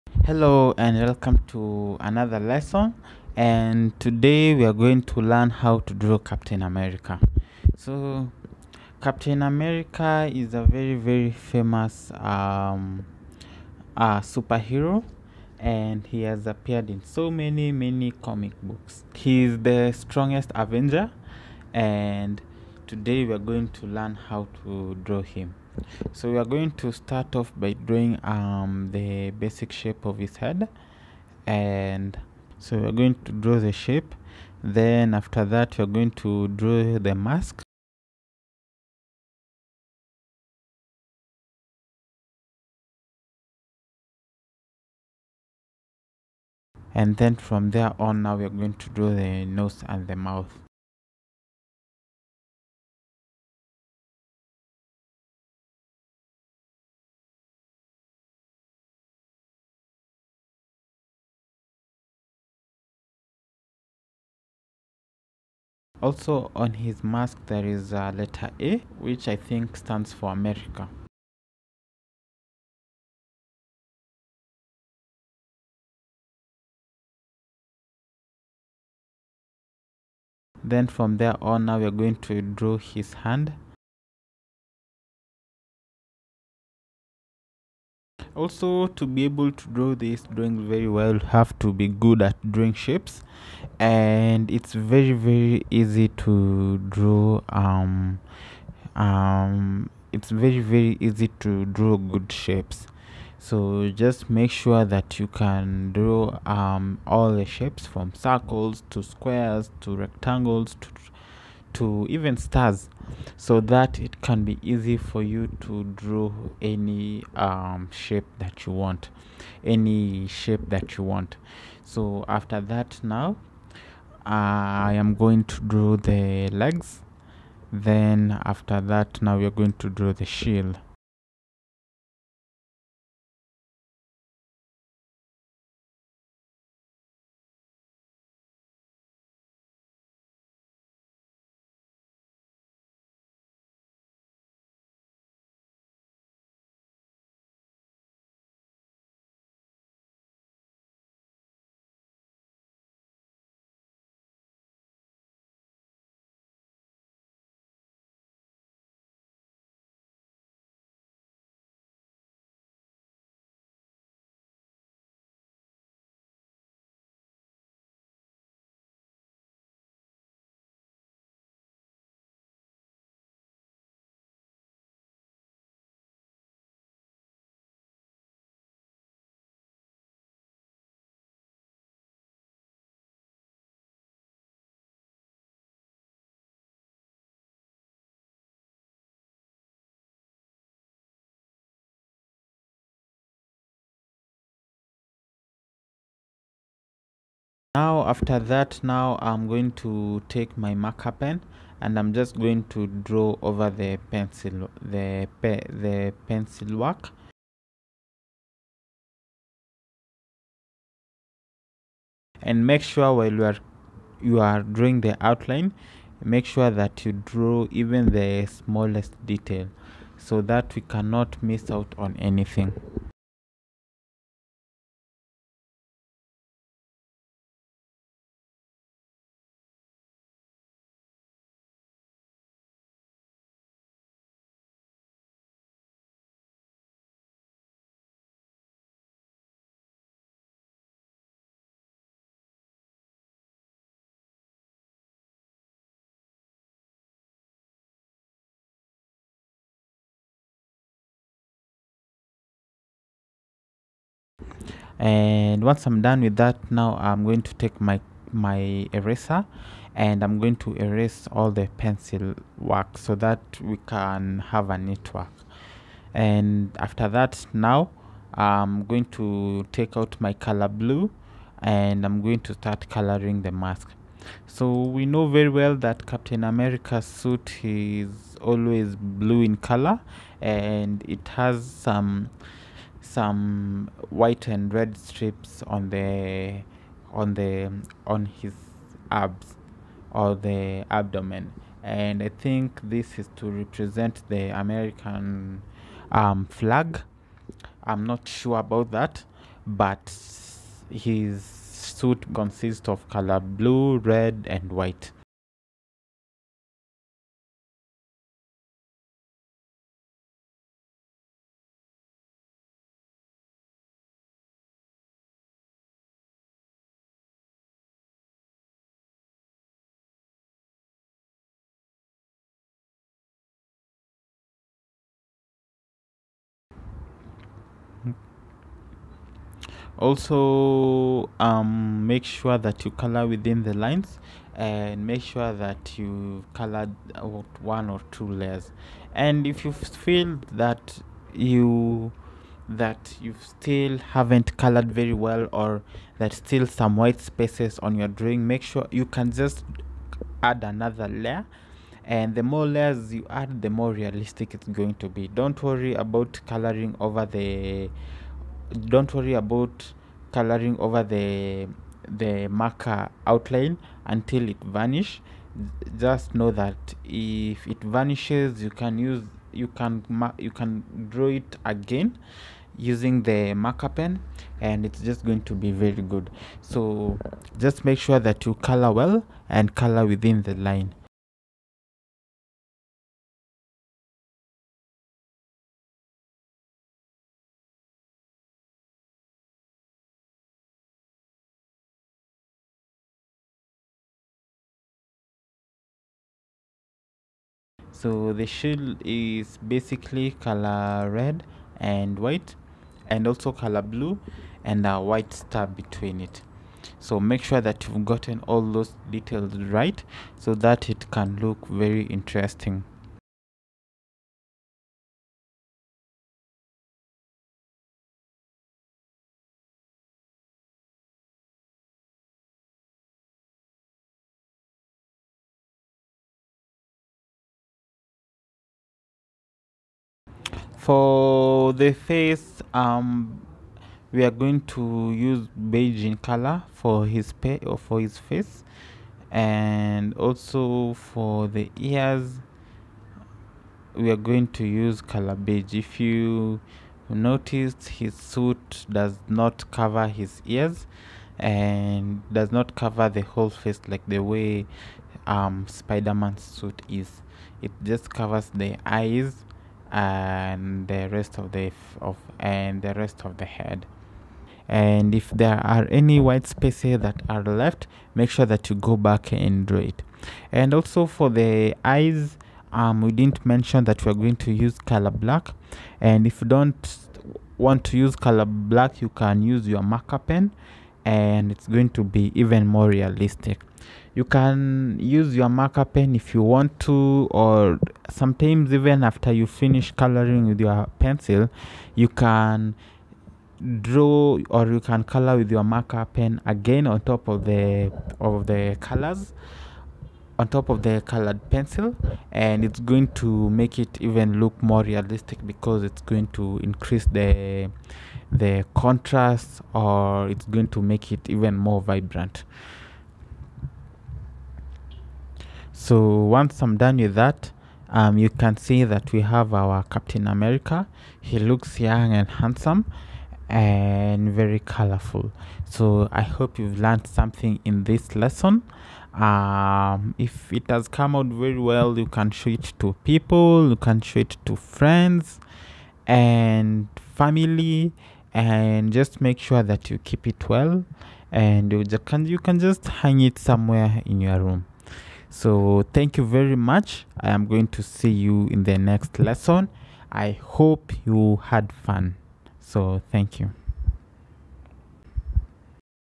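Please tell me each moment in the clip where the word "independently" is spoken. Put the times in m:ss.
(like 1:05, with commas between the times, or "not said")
not said.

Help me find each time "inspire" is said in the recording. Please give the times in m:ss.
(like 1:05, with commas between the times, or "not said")
not said.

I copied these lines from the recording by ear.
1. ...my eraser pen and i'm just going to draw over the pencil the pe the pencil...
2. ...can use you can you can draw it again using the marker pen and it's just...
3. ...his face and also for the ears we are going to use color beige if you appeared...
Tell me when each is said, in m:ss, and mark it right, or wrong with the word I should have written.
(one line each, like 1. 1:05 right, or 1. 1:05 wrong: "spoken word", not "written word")
1. 3:20 wrong: "marker", not "eraser"
2. 6:08 right
3. 7:18 wrong: "noticed", not "appeared".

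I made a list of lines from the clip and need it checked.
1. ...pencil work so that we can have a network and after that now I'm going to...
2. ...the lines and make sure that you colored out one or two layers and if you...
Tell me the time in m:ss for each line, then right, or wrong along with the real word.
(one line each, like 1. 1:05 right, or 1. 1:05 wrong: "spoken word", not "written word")
1. 4:21 right
2. 5:33 right.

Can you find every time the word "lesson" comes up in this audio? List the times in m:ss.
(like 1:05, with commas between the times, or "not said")
0:02, 8:48, 9:09.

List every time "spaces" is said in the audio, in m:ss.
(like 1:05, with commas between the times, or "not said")
5:47, 7:46.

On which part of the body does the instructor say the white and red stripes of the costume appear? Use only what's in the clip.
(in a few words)
the abdomen.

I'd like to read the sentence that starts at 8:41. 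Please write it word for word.
He looks young and handsome and very colorful.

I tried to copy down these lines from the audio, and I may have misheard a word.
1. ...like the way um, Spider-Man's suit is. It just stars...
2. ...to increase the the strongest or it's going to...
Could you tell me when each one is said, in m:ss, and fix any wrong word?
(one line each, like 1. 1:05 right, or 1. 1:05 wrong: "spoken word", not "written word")
1. 7:33 wrong: "covers", not "stars"
2. 8:26 wrong: "contrast", not "strongest".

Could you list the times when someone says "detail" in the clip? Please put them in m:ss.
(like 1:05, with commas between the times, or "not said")
3:39, 6:49.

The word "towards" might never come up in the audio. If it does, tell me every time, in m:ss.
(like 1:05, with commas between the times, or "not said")
not said.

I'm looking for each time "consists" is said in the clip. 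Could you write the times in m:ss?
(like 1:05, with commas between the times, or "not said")
5:02.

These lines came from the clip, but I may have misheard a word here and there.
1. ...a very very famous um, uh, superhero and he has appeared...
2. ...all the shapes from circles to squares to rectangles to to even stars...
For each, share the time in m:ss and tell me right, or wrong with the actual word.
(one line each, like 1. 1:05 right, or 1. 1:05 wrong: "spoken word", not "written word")
1. 0:10 right
2. 1:47 right.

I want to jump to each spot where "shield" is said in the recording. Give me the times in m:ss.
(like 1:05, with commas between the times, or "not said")
2:10, 6:38.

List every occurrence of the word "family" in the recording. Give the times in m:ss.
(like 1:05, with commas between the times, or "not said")
8:57.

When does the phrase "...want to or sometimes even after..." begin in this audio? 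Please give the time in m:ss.
8:06.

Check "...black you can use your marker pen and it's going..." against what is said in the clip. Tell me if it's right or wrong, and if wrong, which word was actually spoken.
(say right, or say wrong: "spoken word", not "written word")
right.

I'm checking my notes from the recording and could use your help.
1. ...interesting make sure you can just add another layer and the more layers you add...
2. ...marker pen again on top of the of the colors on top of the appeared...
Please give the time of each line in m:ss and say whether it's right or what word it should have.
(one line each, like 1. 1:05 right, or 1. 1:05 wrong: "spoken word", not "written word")
1. 5:48 wrong: "drawing", not "interesting"
2. 8:15 wrong: "colored", not "appeared".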